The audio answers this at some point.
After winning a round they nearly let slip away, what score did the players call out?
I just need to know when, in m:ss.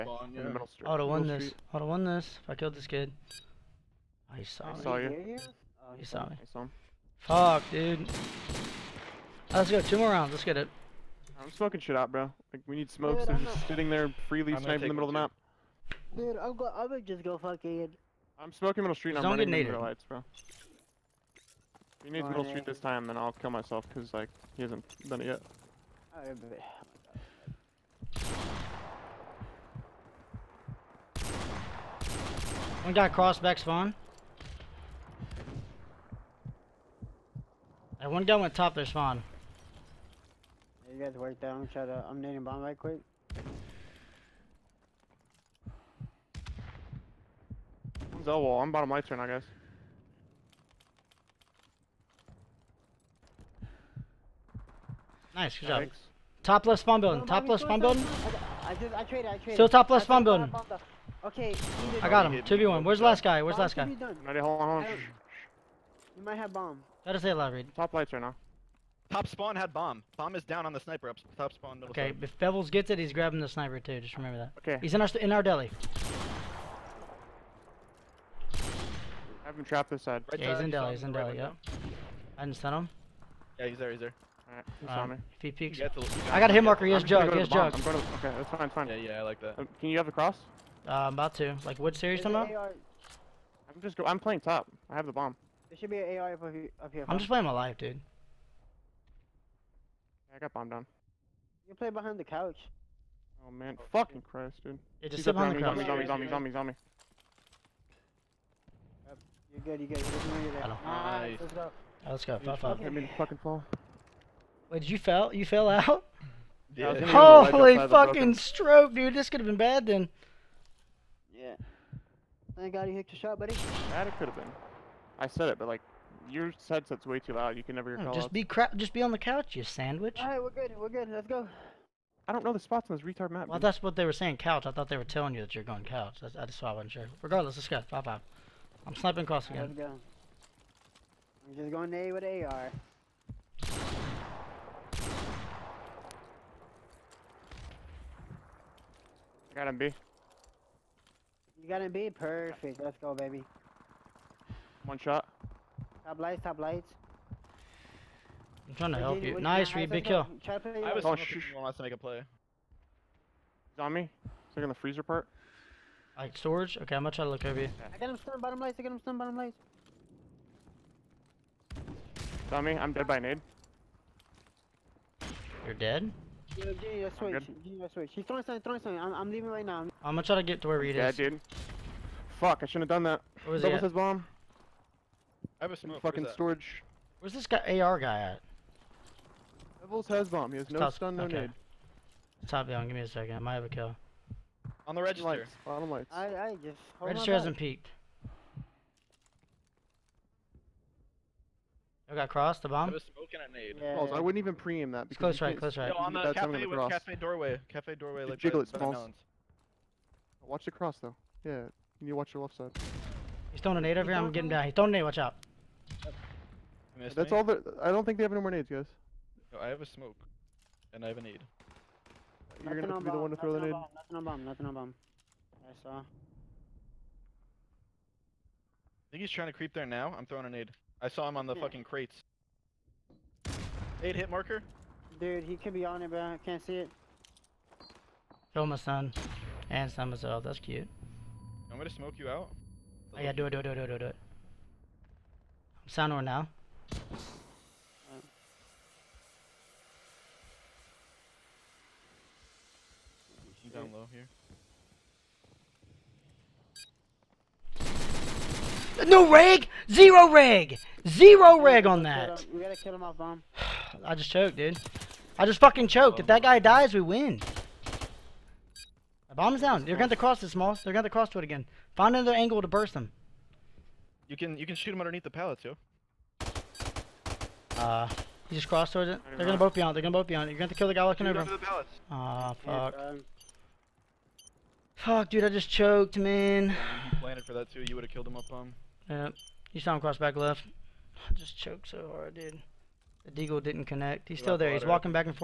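1:52.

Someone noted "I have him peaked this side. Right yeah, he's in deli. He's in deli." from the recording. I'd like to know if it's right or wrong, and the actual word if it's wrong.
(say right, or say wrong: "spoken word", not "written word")
wrong: "trapped", not "peaked".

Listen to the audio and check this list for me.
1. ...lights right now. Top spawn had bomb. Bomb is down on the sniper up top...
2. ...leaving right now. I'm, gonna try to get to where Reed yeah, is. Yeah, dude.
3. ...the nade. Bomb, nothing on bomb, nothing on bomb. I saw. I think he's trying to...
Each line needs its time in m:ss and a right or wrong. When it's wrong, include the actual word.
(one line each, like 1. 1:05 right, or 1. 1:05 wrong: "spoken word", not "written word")
1. 1:07 right
2. 2:59 right
3. 3:43 right.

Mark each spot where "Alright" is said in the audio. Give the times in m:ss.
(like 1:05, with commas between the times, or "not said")
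1:24.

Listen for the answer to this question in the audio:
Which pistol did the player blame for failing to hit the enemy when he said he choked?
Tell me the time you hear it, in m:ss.
4:53.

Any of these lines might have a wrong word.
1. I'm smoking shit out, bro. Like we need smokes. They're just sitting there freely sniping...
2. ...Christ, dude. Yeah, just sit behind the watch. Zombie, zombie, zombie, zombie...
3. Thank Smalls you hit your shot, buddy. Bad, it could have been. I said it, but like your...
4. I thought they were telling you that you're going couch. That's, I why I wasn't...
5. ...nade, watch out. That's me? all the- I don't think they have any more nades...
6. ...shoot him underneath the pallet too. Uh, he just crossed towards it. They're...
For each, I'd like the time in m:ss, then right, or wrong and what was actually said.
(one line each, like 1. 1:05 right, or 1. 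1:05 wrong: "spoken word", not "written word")
1. 0:11 right
2. 1:44 wrong: "couch", not "watch"
3. 2:02 wrong: "God", not "Smalls"
4. 2:14 right
5. 3:34 right
6. 4:34 right.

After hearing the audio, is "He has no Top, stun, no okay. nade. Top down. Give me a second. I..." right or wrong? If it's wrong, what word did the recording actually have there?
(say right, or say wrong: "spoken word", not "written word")
right.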